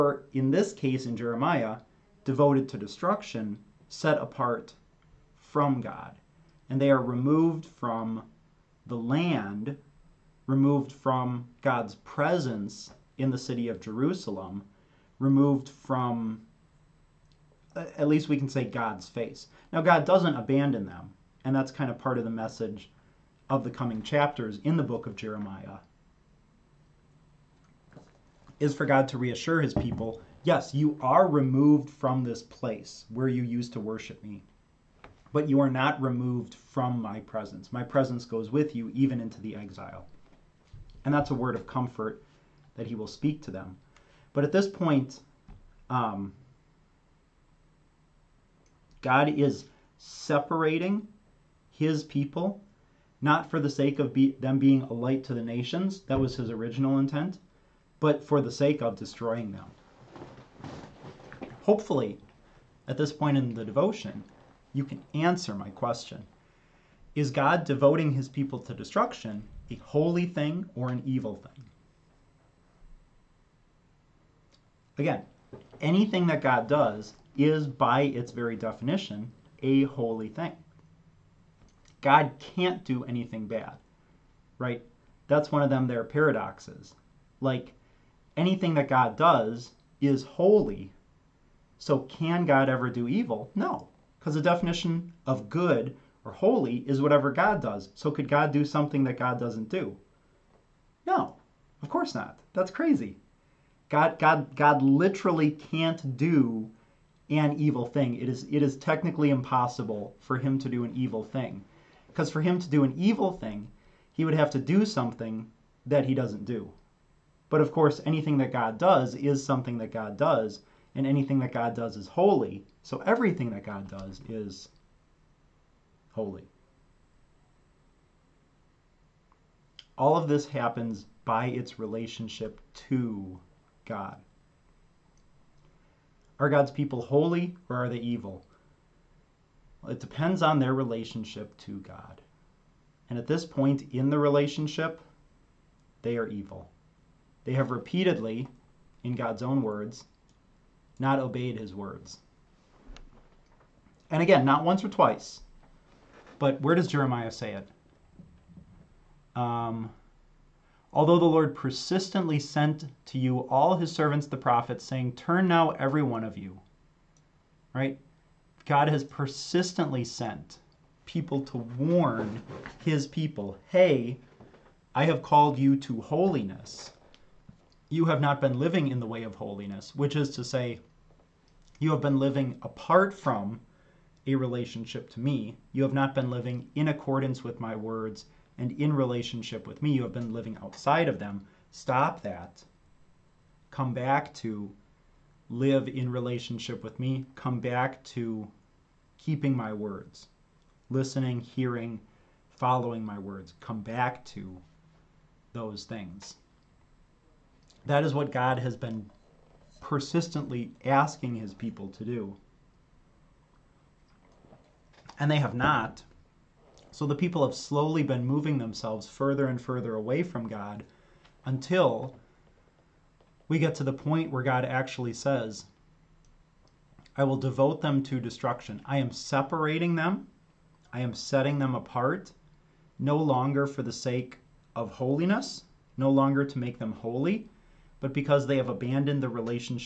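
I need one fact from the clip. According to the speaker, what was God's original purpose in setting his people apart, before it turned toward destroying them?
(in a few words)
a light to the nations.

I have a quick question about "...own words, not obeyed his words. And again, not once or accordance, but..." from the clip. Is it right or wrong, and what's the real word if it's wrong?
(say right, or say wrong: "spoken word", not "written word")
wrong: "twice", not "accordance".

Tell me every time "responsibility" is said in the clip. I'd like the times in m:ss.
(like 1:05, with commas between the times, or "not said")
not said.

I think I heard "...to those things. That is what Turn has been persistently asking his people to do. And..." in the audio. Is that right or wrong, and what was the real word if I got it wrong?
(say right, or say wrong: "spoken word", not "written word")
wrong: "God", not "Turn".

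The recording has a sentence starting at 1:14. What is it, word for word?
Again, anything that God does is, by its very definition, a holy thing.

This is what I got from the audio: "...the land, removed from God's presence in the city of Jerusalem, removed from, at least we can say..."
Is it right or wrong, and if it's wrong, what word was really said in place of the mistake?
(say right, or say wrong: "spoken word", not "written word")
right.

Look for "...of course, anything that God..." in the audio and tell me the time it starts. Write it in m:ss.
1:57.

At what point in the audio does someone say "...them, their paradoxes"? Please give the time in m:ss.
1:25.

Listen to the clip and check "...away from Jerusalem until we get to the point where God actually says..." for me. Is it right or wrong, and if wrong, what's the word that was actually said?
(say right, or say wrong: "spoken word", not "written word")
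wrong: "God", not "Jerusalem".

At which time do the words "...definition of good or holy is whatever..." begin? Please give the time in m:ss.
1:34.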